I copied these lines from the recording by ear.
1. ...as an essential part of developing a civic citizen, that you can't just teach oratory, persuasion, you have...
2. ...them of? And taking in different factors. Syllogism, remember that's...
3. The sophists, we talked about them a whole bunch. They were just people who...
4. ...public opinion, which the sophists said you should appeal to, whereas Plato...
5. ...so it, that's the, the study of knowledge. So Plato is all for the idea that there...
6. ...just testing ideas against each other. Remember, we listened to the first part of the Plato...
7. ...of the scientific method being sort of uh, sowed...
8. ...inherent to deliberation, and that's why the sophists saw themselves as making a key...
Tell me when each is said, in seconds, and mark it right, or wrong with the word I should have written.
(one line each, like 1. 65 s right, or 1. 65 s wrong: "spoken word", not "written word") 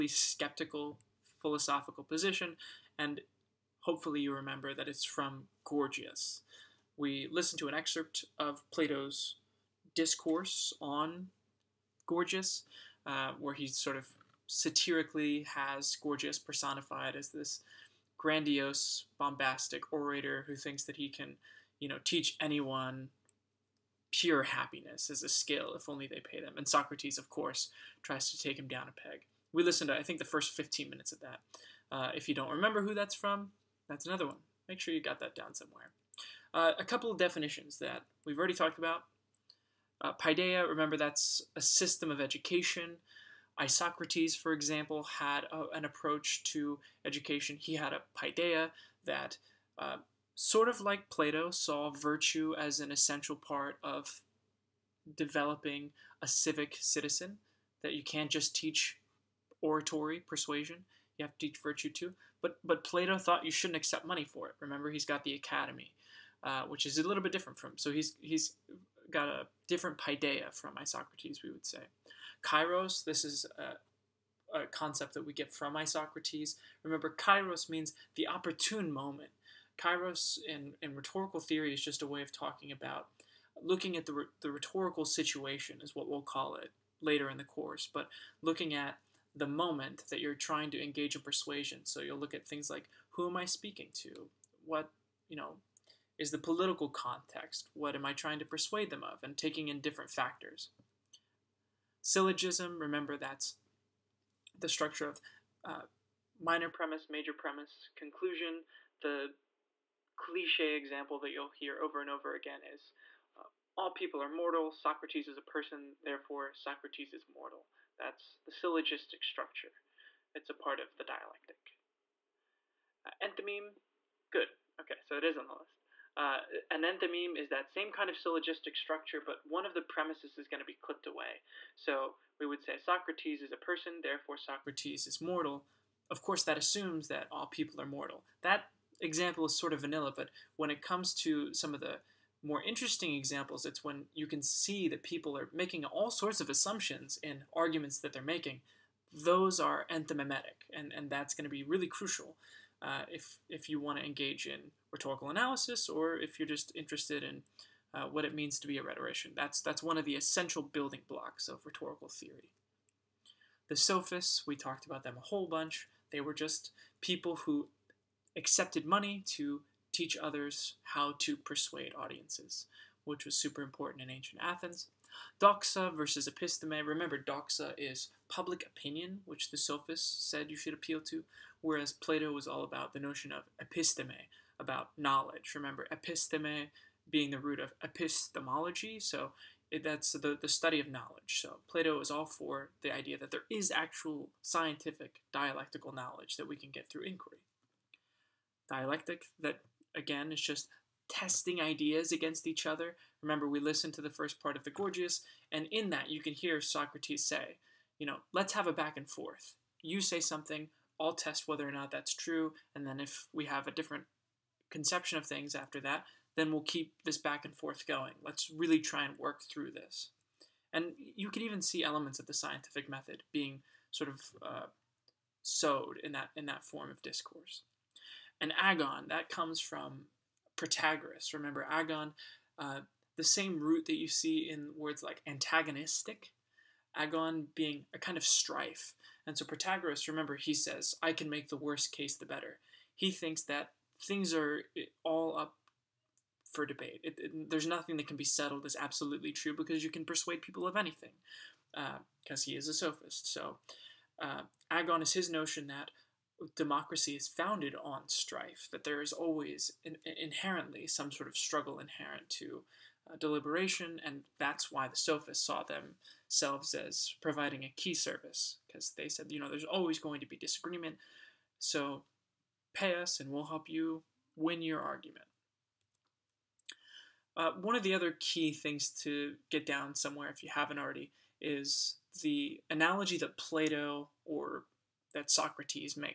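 1. 52 s right
2. 98 s right
3. 163 s right
4. 178 s right
5. 188 s right
6. 200 s wrong: "Gorgias", not "Plato"
7. 222 s right
8. 261 s wrong: "providing", not "making".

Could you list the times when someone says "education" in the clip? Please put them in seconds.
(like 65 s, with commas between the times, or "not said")
42 s, 47 s.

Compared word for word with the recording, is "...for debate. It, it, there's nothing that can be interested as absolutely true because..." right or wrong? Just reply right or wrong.
wrong.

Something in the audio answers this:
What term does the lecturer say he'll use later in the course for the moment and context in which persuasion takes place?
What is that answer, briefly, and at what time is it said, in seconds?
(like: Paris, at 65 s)
rhetorical situation, at 84 s.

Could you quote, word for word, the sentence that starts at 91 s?
So you'll look at things like who am I speaking to?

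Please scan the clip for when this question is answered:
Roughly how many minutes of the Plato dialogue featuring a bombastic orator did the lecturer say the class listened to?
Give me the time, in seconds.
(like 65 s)
30 s.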